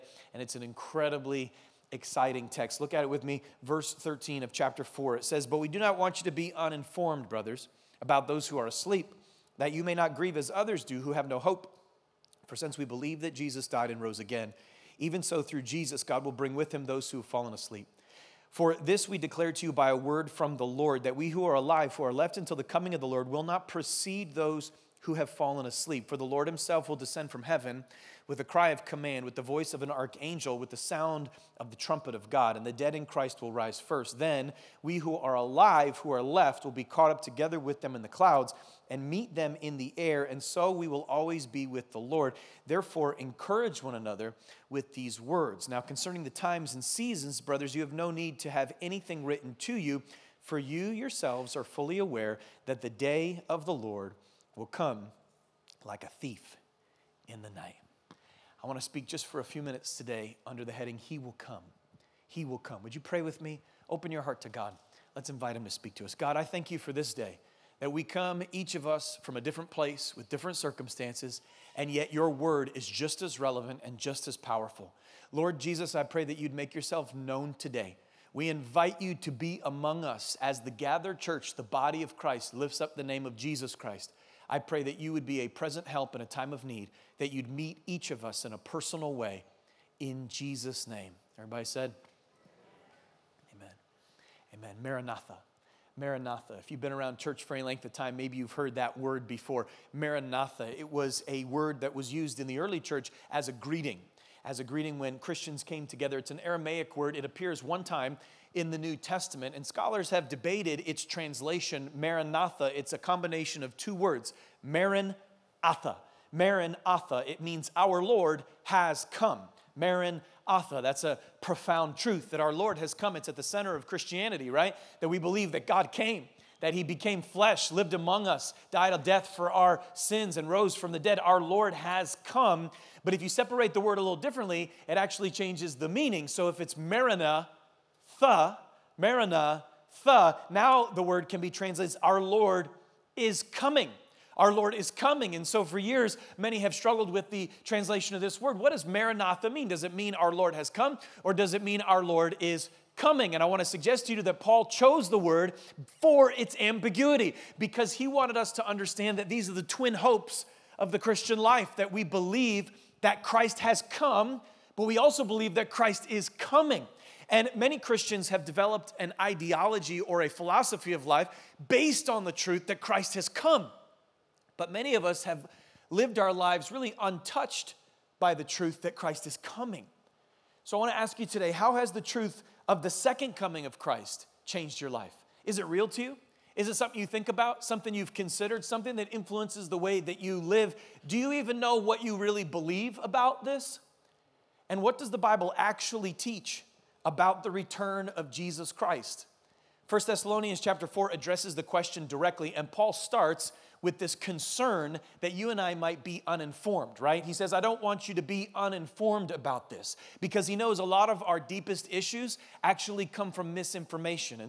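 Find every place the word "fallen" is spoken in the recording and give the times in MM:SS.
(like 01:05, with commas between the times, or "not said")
00:17, 00:25.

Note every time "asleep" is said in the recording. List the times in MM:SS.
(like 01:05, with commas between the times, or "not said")
00:08, 00:17, 00:25.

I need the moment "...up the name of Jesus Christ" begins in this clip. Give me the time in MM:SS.
01:22.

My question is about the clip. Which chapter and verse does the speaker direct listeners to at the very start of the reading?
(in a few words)
Verse 13 of chapter 4.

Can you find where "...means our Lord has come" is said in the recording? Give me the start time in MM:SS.
01:57.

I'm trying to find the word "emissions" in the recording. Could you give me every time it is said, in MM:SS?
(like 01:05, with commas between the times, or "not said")
not said.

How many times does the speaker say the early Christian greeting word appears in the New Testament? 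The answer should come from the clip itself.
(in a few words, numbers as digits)
1.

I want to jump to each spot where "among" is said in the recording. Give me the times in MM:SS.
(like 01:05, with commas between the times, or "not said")
01:19, 02:07.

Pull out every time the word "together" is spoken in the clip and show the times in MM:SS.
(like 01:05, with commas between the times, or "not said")
00:37, 01:45.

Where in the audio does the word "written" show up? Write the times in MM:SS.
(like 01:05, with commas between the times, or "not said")
00:49.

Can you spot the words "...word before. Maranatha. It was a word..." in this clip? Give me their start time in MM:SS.
01:38.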